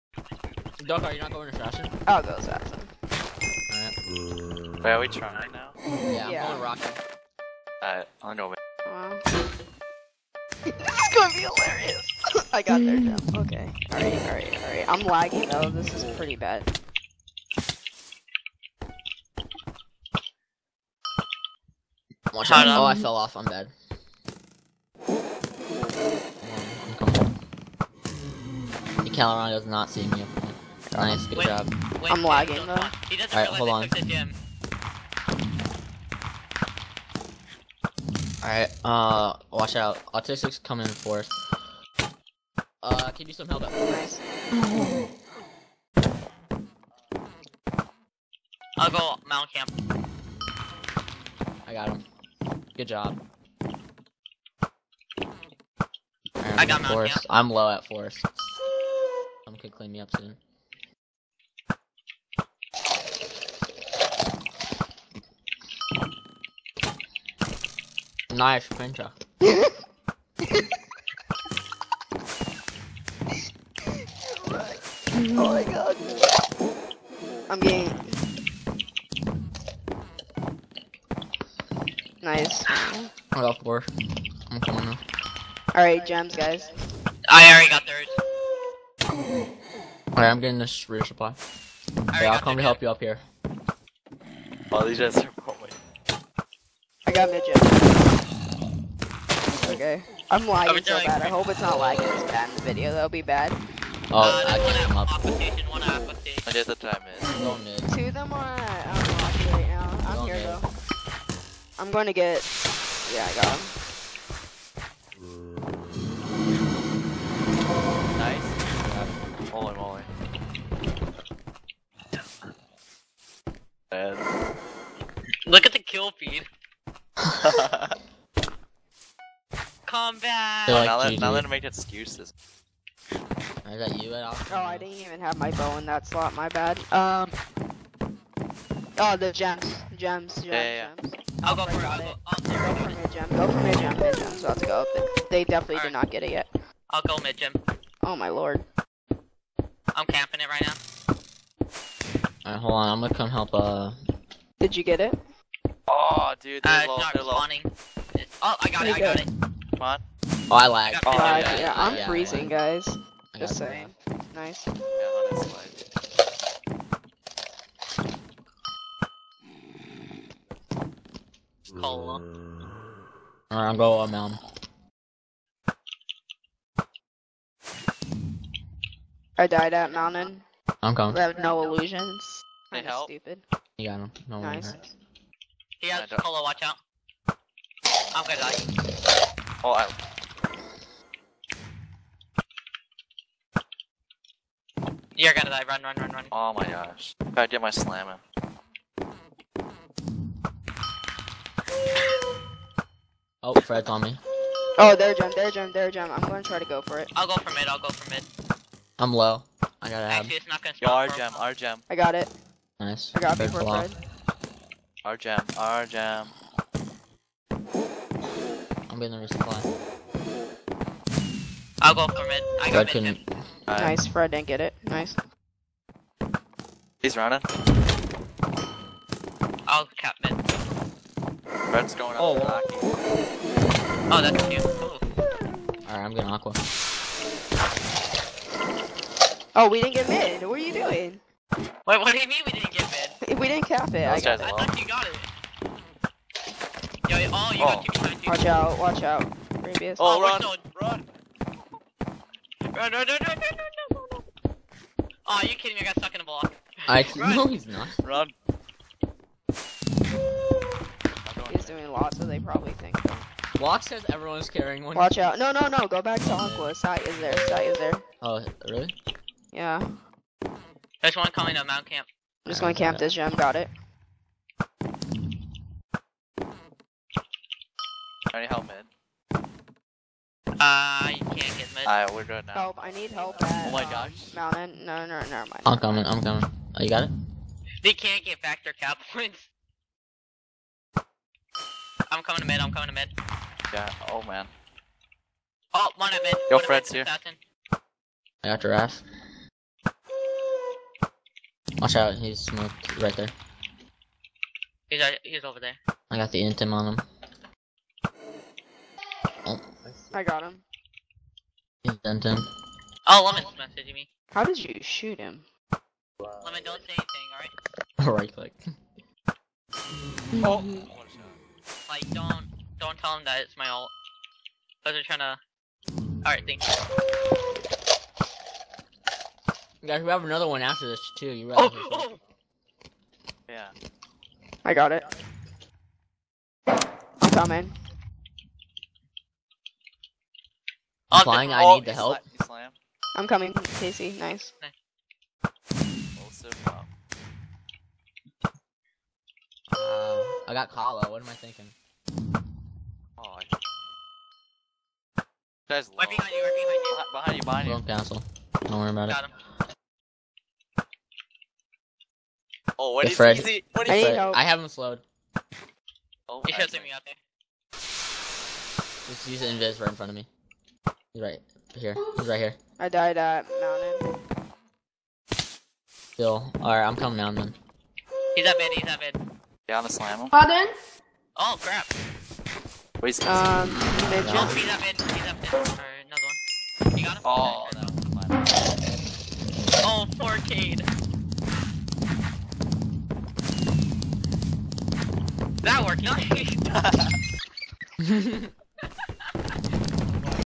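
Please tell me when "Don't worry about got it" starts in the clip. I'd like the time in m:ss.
5:58.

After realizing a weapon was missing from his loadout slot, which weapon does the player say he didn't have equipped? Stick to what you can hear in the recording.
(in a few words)
bow.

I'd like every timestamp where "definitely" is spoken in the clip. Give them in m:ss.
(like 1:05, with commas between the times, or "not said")
2:25.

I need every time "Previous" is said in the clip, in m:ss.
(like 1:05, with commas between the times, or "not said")
4:09.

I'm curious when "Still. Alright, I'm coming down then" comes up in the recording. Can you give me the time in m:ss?
6:15.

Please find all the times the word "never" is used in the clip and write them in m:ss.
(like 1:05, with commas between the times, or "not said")
4:45.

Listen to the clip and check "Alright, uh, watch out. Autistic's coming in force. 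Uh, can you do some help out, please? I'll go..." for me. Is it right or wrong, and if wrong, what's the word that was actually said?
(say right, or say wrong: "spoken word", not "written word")
right.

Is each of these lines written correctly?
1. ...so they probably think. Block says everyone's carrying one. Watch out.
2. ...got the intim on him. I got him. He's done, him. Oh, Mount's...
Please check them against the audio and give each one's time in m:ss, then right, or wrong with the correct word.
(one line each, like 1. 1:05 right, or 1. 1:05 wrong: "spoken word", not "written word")
1. 4:22 right
2. 5:06 wrong: "Lemon", not "Mount".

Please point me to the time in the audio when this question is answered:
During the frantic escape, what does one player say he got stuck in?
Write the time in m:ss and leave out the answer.
4:15.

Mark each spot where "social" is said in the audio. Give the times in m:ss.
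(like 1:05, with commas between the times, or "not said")
not said.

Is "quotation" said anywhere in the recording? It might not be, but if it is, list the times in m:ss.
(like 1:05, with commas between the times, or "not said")
not said.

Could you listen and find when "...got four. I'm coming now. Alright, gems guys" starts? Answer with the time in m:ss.
1:23.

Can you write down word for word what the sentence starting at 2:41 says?
Oh, yeah, I'm yeah, freezing, guys.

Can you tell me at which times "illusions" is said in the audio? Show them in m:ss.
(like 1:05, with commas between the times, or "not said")
3:01.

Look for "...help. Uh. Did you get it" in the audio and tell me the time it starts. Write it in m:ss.
2:33.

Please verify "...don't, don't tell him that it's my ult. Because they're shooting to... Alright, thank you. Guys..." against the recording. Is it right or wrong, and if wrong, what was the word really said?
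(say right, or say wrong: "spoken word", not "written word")
wrong: "trying", not "shooting".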